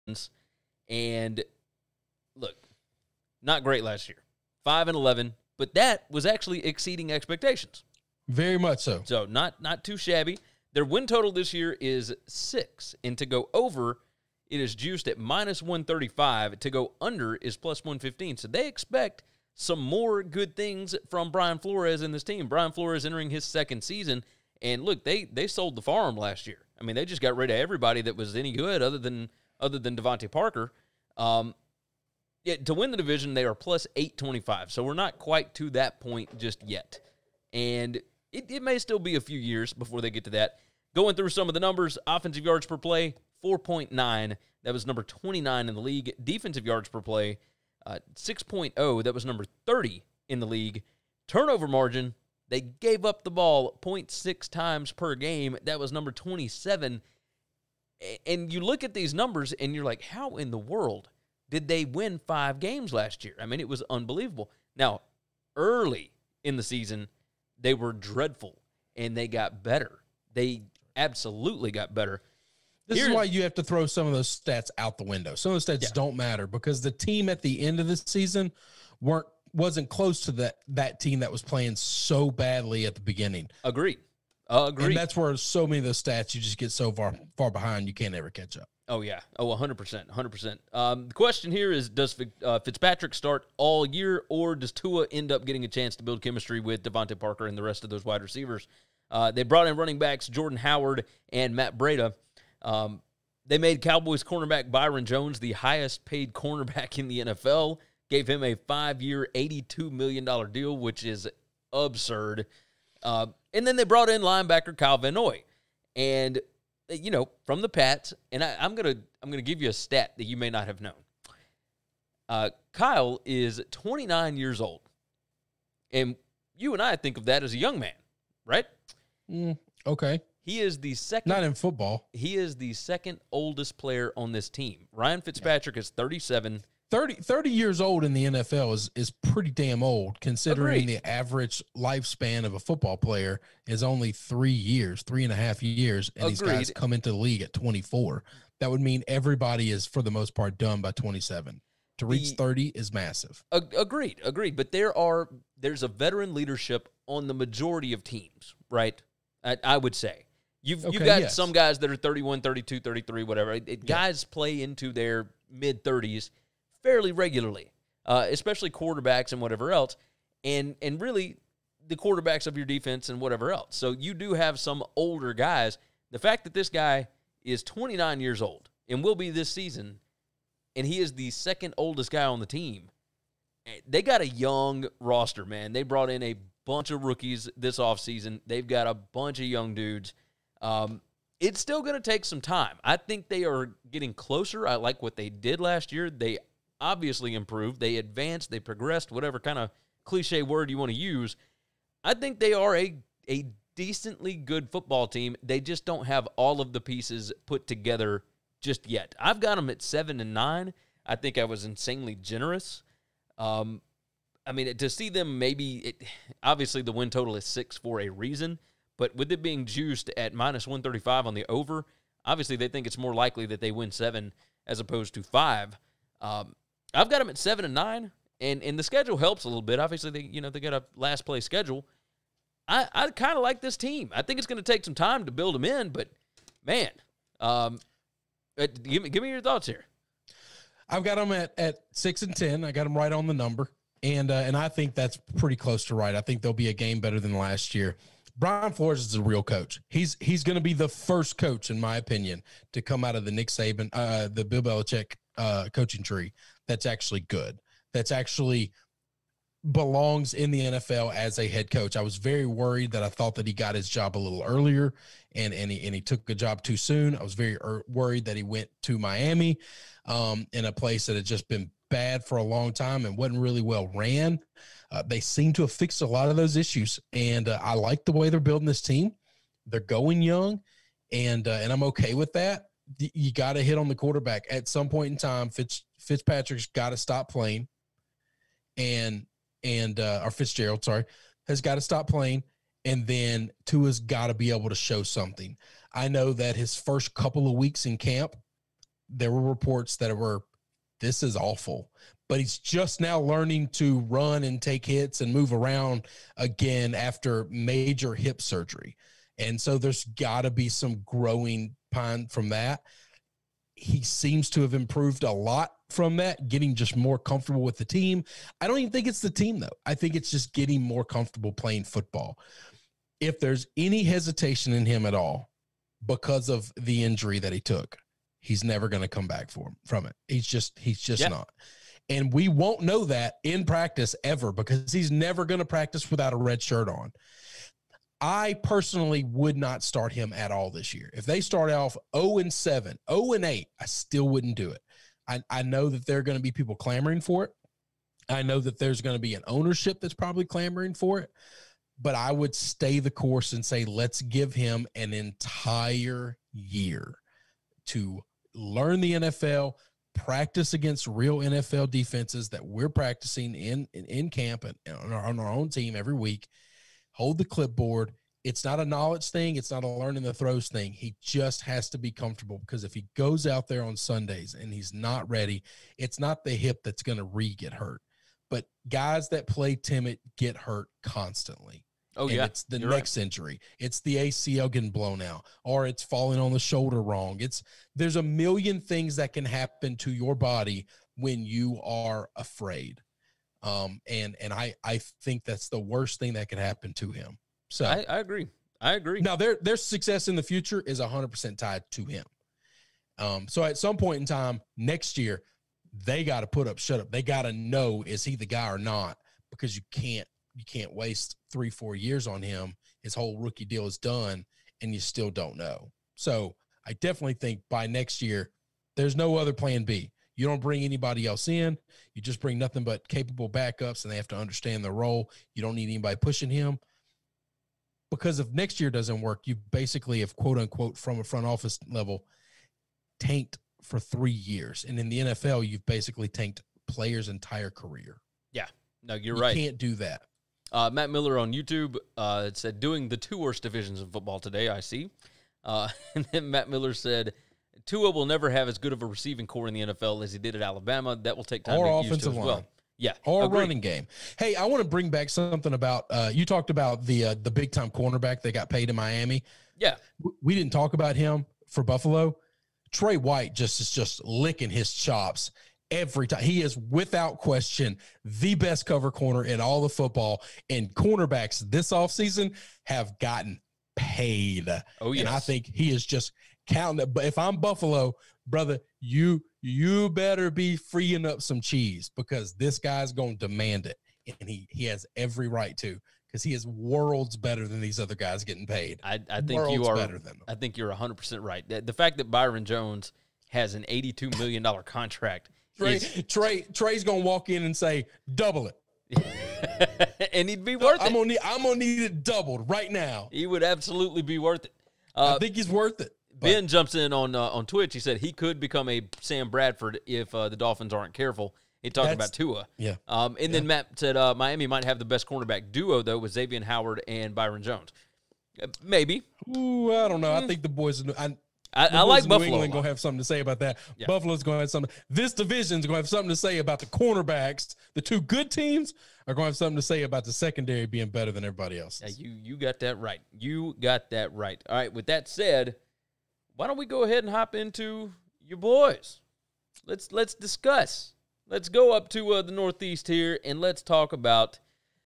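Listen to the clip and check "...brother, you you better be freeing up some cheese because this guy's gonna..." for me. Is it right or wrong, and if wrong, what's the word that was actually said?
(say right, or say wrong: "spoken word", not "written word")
right.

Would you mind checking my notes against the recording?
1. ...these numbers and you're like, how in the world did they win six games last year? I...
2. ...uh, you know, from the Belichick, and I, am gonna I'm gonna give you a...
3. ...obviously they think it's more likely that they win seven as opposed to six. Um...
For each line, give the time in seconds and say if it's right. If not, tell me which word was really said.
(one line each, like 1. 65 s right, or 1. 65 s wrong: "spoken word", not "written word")
1. 58 s wrong: "five", not "six"
2. 116 s wrong: "Pats", not "Belichick"
3. 222 s wrong: "five", not "six".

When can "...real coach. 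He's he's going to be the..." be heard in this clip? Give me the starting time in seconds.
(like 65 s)
249 s.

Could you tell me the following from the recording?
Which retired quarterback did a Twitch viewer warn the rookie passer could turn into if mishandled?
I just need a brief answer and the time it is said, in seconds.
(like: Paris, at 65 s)
Sam Bradford, at 509 s.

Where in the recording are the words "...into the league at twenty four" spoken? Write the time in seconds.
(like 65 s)
146 s.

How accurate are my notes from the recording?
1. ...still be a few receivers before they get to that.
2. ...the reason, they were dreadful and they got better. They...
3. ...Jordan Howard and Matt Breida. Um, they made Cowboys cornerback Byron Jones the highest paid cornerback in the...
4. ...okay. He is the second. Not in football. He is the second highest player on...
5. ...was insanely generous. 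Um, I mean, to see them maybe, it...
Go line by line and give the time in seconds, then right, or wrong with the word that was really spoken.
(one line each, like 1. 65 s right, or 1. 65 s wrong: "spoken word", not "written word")
1. 38 s wrong: "years", not "receivers"
2. 66 s wrong: "season", not "reason"
3. 100 s right
4. 129 s wrong: "oldest", not "highest"
5. 211 s right.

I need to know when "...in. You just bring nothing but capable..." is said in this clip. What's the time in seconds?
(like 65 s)
421 s.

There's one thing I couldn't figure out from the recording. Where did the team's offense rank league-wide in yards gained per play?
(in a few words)
29.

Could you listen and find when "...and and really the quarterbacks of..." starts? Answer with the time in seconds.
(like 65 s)
170 s.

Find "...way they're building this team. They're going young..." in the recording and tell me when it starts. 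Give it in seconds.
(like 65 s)
278 s.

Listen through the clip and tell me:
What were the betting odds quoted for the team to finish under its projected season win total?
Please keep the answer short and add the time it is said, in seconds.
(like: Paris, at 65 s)
+115, at 17 s.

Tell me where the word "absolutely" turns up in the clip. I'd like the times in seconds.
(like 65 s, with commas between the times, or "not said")
70 s, 503 s.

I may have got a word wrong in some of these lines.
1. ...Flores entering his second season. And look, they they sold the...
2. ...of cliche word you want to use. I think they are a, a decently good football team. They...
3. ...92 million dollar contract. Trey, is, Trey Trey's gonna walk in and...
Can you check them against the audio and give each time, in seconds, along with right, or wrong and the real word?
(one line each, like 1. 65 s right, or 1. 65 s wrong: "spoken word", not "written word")
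1. 22 s right
2. 199 s right
3. 493 s wrong: "82", not "92".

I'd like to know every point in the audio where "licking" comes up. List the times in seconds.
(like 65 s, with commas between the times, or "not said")
464 s.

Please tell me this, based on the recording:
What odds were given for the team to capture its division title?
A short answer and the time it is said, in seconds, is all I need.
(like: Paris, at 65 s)
+825, at 33 s.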